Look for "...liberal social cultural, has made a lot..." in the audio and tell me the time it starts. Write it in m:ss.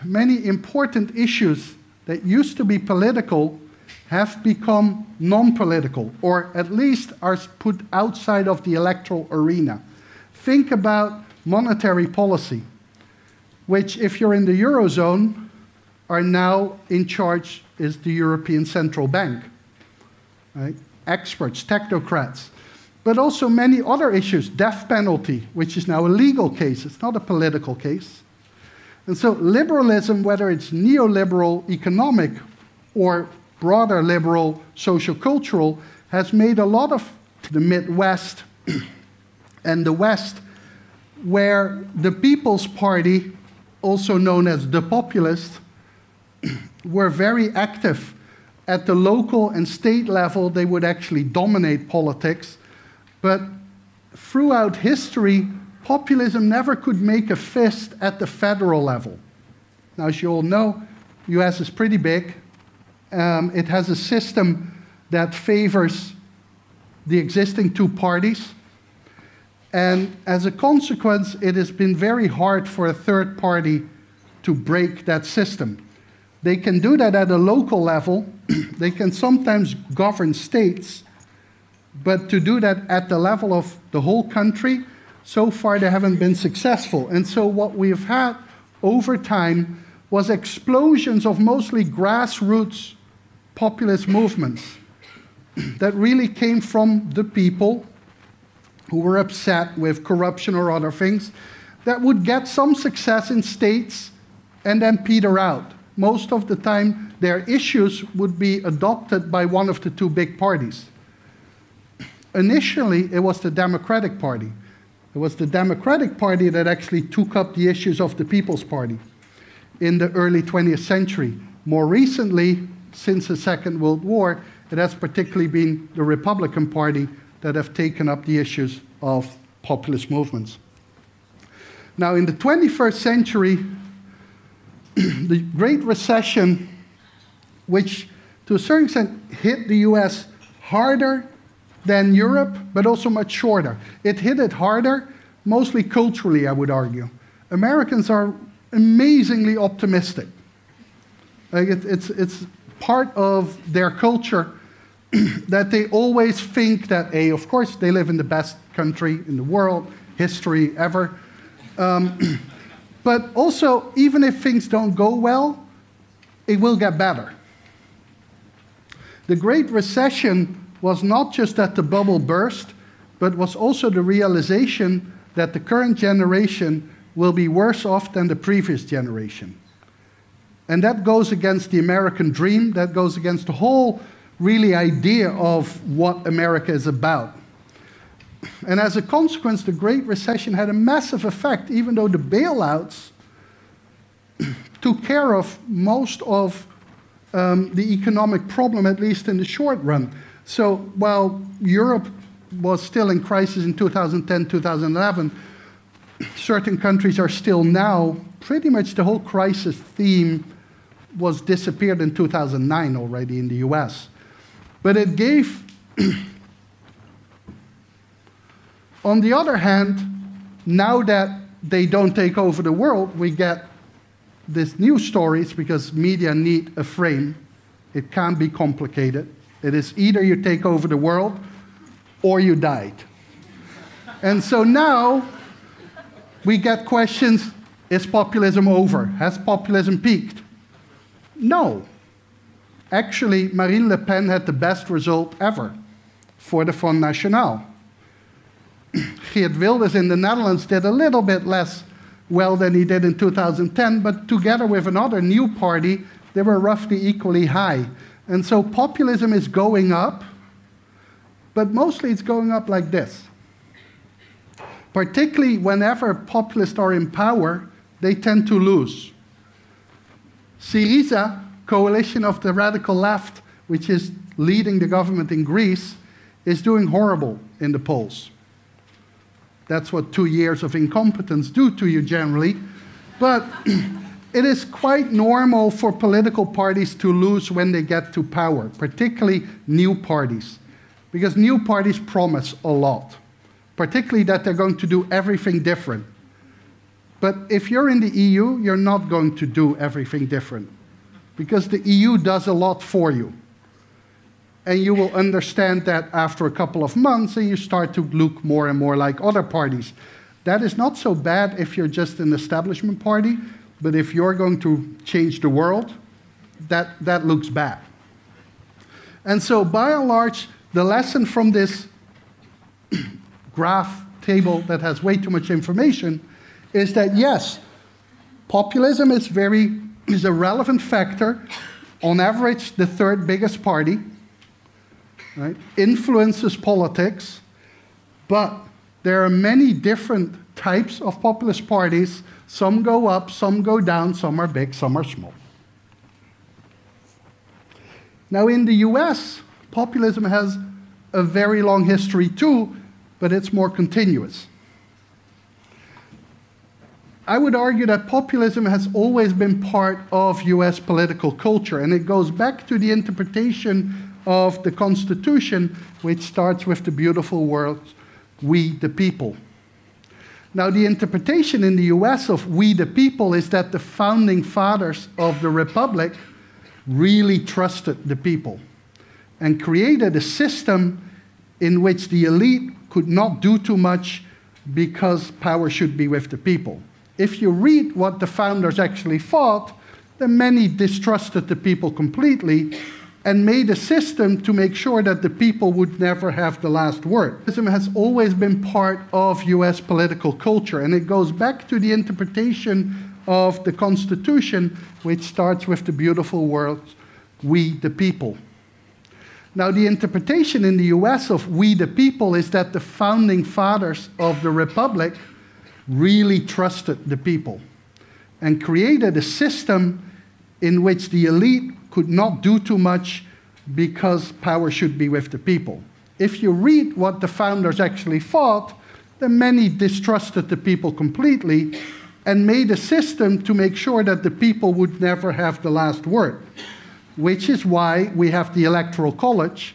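0:34.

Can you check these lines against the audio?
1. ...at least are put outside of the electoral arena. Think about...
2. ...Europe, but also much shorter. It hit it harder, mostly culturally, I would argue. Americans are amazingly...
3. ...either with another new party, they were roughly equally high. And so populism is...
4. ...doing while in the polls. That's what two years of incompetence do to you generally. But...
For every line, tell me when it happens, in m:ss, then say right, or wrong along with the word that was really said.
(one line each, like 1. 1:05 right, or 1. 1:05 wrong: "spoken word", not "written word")
1. 0:06 right
2. 2:22 right
3. 4:14 wrong: "together", not "either"
4. 4:36 wrong: "horrible", not "while".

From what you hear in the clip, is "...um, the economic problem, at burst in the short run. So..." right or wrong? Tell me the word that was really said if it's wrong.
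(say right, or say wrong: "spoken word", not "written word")
wrong: "least", not "burst".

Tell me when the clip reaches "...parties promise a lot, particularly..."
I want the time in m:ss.
4:51.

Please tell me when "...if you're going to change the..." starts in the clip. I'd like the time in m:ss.
5:13.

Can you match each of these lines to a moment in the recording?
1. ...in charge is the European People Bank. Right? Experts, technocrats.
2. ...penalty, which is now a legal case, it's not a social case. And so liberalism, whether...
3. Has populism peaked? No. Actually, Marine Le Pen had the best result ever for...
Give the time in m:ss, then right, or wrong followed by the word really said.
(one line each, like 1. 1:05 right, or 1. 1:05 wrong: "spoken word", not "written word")
1. 0:16 wrong: "Central", not "People"
2. 0:24 wrong: "political", not "social"
3. 3:59 right.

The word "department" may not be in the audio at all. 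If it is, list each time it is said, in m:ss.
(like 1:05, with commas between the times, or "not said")
not said.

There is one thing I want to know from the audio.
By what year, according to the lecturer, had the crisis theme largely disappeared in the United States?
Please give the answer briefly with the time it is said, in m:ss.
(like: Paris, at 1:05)
2009, at 3:32.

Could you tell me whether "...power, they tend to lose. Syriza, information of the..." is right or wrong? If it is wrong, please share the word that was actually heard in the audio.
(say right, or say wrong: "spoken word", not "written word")
wrong: "coalition", not "information".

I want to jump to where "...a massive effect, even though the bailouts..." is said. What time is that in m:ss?
3:10.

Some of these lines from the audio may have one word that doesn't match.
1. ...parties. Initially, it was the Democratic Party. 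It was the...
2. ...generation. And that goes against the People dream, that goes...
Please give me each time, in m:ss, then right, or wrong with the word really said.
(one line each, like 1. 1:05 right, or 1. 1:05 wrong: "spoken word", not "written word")
1. 1:50 right
2. 2:58 wrong: "American", not "People".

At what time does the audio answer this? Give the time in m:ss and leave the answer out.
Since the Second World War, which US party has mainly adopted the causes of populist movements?
2:06.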